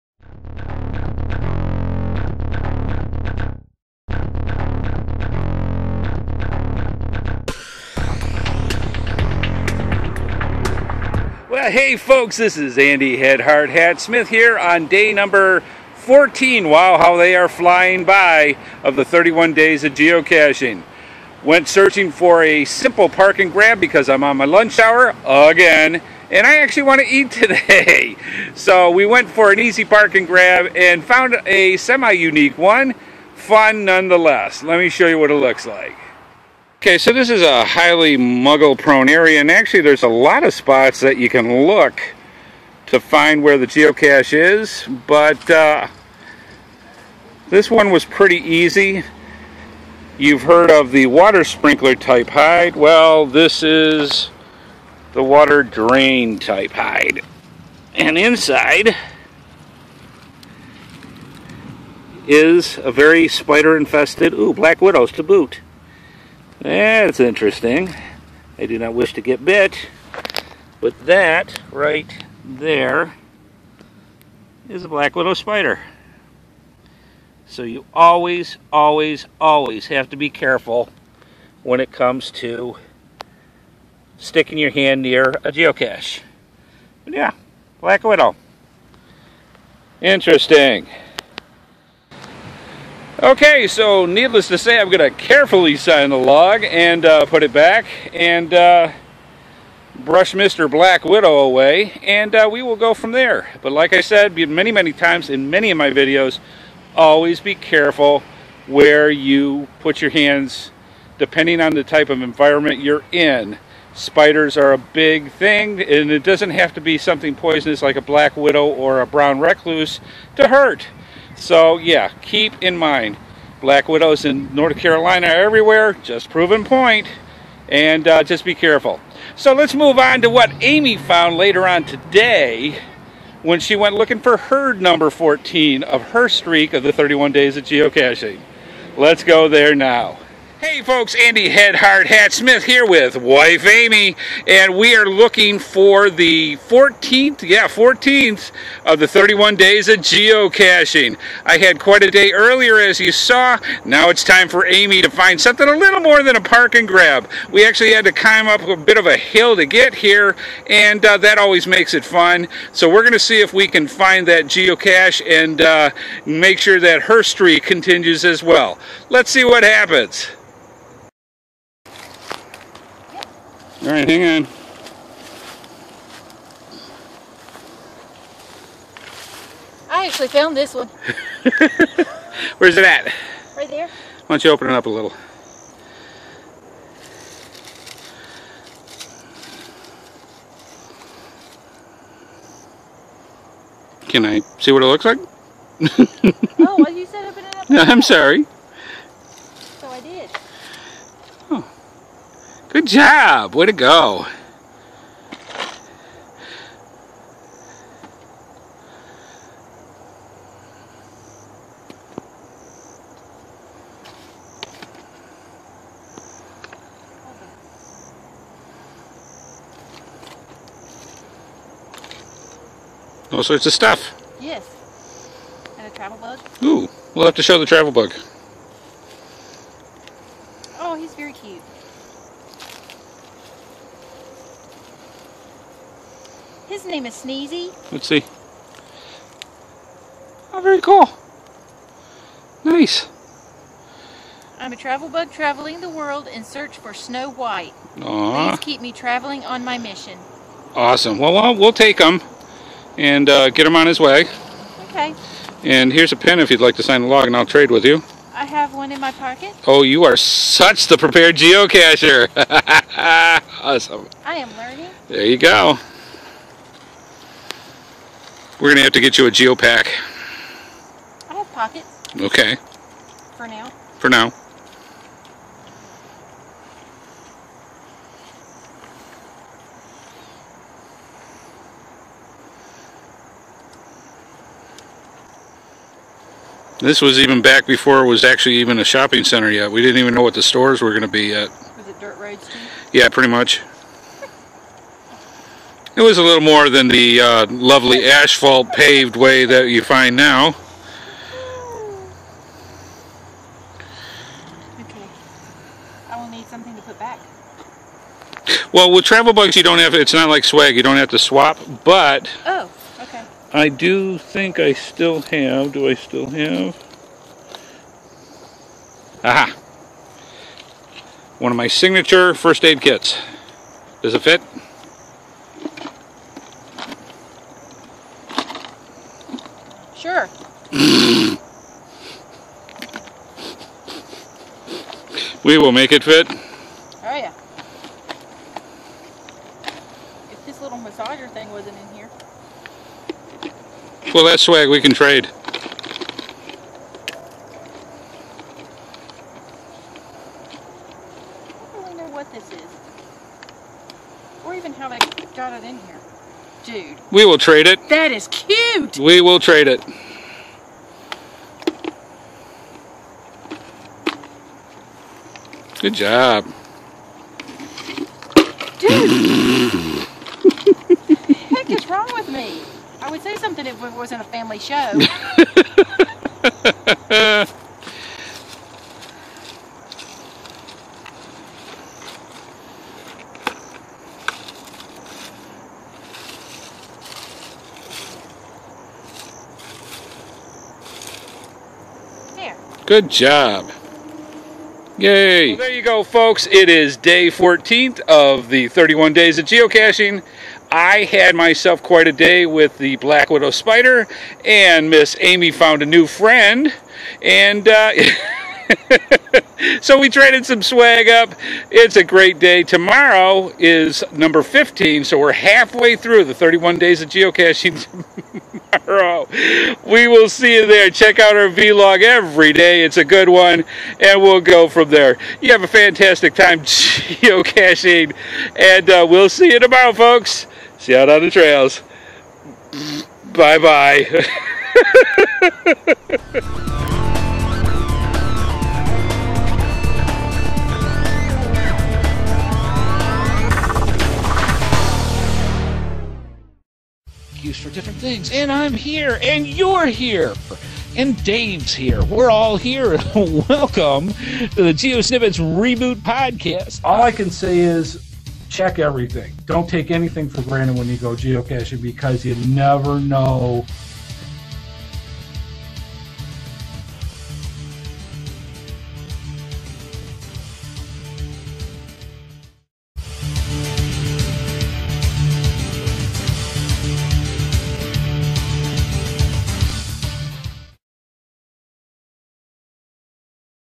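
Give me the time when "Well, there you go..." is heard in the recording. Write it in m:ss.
6:35.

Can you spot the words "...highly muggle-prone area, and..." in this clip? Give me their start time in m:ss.
0:37.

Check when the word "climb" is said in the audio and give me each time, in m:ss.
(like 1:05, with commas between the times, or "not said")
2:38.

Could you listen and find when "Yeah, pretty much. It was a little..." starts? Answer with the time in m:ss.
4:52.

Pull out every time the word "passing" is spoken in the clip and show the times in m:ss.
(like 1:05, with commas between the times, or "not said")
not said.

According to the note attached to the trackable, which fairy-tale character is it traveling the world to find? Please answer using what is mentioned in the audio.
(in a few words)
Snow White.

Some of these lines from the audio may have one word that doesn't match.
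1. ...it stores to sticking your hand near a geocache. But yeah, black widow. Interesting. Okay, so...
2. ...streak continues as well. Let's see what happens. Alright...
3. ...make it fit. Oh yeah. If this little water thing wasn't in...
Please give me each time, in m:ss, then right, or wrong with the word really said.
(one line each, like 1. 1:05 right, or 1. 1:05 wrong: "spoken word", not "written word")
1. 1:21 wrong: "comes", not "stores"
2. 2:47 right
3. 5:35 wrong: "massager", not "water".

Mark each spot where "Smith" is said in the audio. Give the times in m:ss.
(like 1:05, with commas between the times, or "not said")
0:13, 2:22.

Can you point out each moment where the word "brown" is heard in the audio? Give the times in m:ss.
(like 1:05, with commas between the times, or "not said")
1:59.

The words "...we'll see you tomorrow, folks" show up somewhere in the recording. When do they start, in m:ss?
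7:09.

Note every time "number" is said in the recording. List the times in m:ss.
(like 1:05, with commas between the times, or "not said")
0:15, 2:14, 6:54.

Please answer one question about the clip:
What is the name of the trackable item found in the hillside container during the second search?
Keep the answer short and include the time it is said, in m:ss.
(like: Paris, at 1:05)
Sneezy, at 3:57.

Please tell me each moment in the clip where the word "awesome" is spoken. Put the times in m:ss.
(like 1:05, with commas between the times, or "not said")
4:10, 4:23.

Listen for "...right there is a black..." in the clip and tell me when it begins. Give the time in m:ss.
1:11.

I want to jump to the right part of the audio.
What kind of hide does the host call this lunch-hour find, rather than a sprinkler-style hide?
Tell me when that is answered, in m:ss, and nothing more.
0:55.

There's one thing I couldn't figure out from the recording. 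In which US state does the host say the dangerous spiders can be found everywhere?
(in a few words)
North Carolina.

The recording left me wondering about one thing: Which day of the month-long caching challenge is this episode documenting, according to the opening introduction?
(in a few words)
14.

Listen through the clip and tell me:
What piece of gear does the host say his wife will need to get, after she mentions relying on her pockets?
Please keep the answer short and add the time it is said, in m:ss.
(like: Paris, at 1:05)
geopack, at 4:29.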